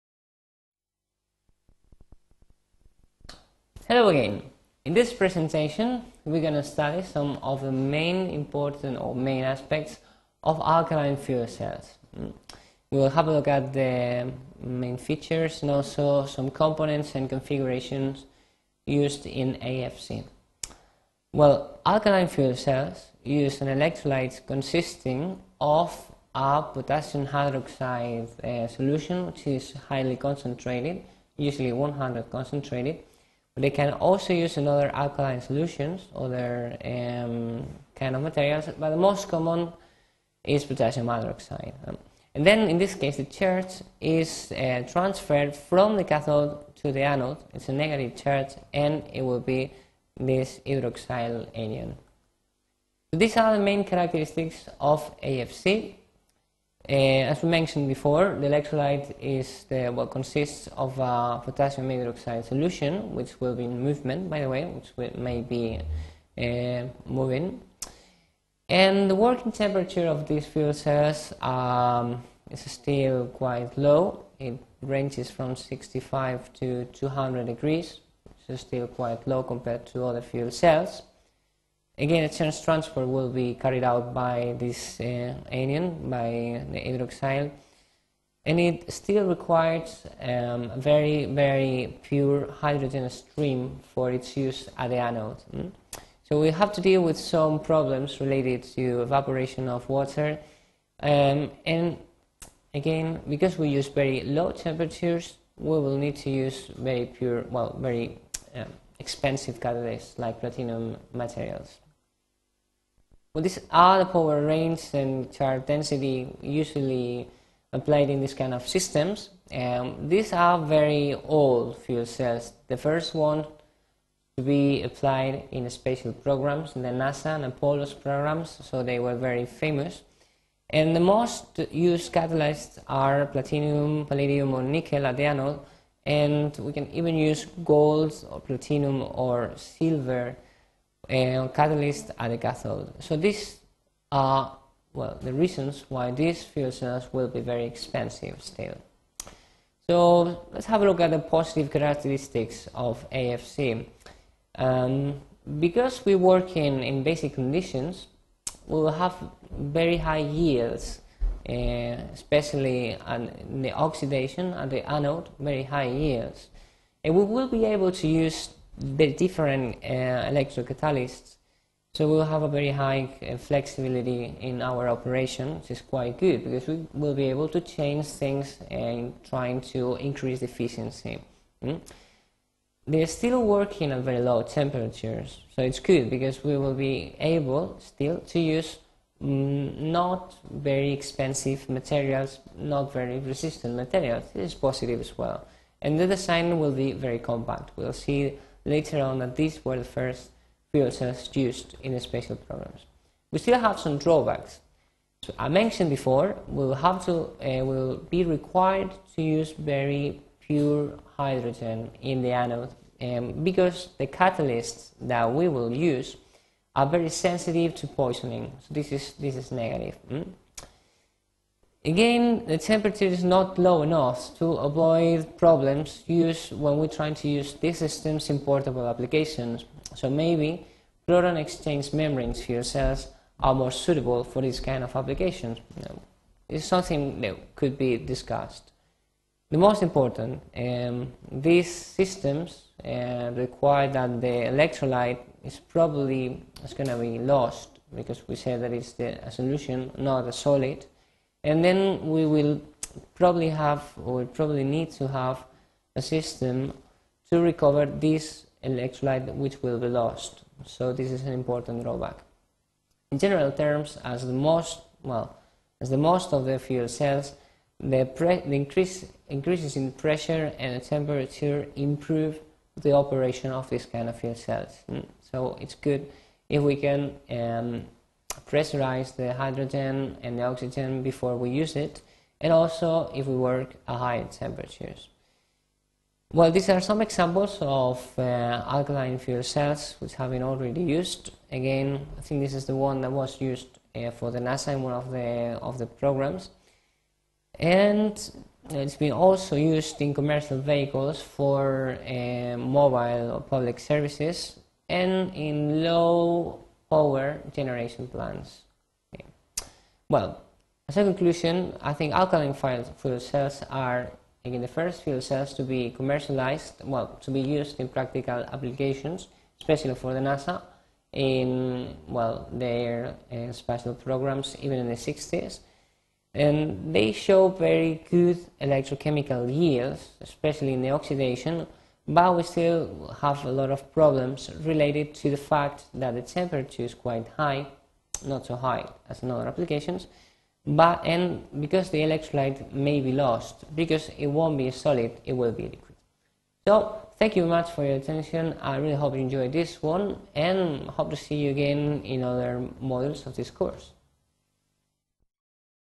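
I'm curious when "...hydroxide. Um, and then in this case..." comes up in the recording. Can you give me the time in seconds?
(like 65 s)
41 s.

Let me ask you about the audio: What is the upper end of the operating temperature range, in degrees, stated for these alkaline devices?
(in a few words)
200.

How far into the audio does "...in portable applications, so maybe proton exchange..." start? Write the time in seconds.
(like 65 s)
228 s.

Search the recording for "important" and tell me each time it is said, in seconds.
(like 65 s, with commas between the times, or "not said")
8 s, 239 s, 261 s.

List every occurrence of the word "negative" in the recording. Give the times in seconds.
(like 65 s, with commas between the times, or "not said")
47 s, 219 s.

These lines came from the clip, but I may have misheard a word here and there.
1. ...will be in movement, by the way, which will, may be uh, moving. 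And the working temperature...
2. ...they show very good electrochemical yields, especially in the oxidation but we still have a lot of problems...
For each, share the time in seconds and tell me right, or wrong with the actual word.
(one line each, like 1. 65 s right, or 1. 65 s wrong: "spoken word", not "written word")
1. 63 s right
2. 326 s right.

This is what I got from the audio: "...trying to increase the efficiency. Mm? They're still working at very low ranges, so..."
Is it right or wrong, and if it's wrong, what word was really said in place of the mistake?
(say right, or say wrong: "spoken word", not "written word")
wrong: "temperatures", not "ranges".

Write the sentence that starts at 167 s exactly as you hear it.
And we will be able to use very different uh, electrocatalysts.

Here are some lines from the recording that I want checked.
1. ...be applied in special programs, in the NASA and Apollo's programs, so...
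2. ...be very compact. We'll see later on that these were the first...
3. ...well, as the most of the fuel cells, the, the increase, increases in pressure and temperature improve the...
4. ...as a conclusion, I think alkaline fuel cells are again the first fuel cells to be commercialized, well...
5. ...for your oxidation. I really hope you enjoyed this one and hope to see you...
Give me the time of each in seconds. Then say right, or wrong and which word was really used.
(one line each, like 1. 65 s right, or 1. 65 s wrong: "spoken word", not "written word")
1. 124 s right
2. 196 s right
3. 265 s right
4. 310 s right
5. 347 s wrong: "attention", not "oxidation".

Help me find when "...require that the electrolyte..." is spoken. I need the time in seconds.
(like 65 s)
243 s.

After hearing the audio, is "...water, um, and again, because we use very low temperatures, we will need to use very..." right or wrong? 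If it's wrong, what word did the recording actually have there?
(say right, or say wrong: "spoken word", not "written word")
right.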